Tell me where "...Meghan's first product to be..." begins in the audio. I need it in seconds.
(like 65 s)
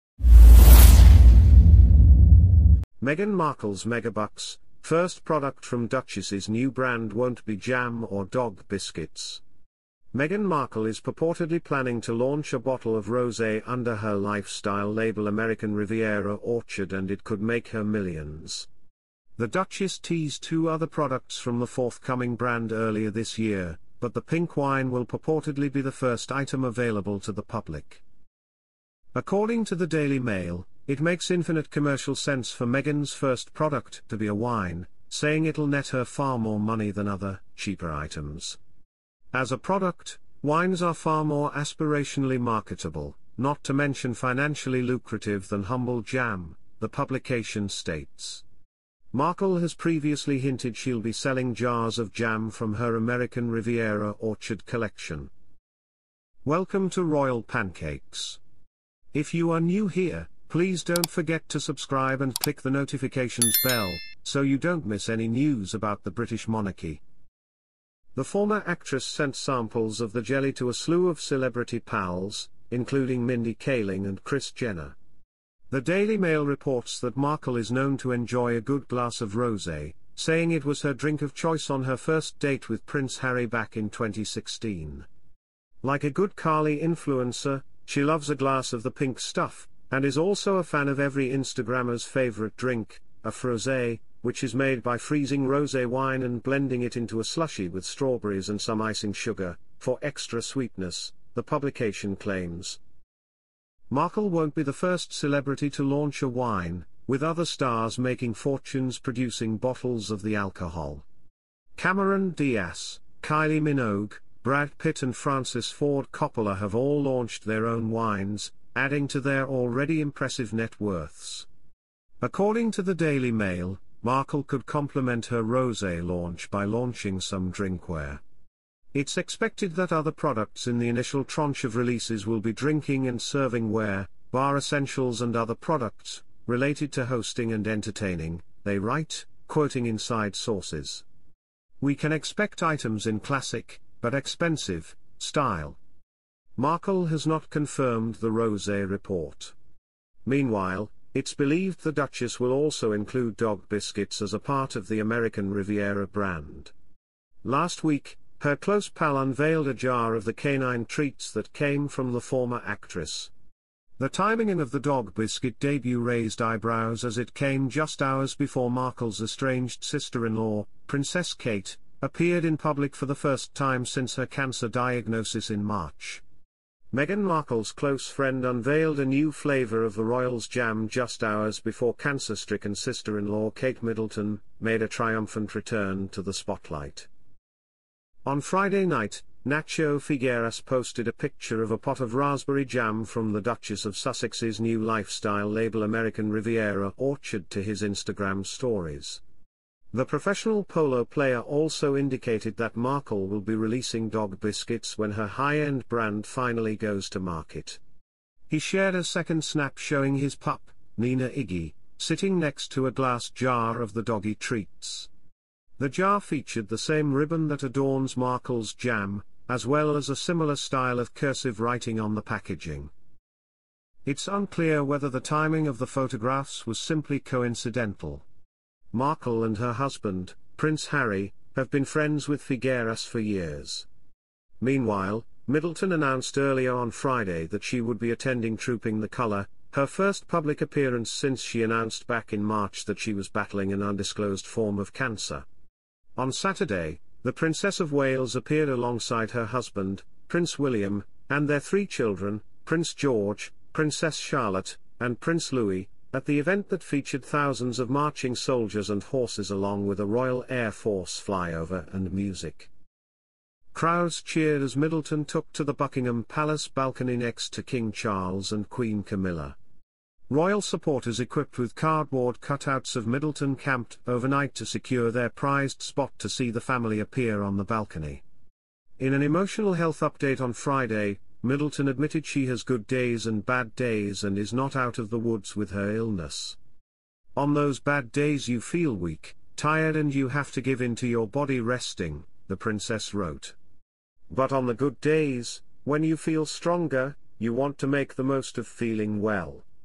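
32 s.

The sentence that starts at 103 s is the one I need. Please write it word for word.
Markle won't be the first celebrity to launch a wine, with other stars making fortunes producing bottles of the alcohol.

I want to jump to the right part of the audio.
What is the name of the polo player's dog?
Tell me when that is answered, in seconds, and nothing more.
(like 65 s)
210 s.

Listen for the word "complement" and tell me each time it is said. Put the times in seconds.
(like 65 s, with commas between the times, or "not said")
124 s.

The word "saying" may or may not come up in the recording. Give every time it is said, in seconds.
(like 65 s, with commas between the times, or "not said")
35 s, 80 s.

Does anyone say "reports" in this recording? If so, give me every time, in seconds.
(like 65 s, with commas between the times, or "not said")
76 s, 148 s.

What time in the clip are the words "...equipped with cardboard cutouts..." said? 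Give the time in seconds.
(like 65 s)
271 s.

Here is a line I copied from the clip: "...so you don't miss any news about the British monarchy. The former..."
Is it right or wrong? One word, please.
right.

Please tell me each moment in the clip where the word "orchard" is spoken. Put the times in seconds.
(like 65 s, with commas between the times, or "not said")
16 s, 54 s, 196 s.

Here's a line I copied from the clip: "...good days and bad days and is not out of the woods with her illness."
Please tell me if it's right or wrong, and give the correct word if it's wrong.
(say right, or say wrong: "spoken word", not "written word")
right.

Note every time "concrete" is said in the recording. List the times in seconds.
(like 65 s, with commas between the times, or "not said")
not said.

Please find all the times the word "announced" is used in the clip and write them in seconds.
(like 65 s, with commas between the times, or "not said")
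235 s, 241 s.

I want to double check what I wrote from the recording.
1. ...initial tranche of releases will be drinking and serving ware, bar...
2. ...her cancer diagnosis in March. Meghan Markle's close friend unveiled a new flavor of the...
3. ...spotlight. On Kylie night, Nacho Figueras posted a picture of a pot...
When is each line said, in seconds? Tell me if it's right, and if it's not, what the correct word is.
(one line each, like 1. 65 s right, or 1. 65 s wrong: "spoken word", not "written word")
1. 130 s right
2. 174 s right
3. 186 s wrong: "Friday", not "Kylie".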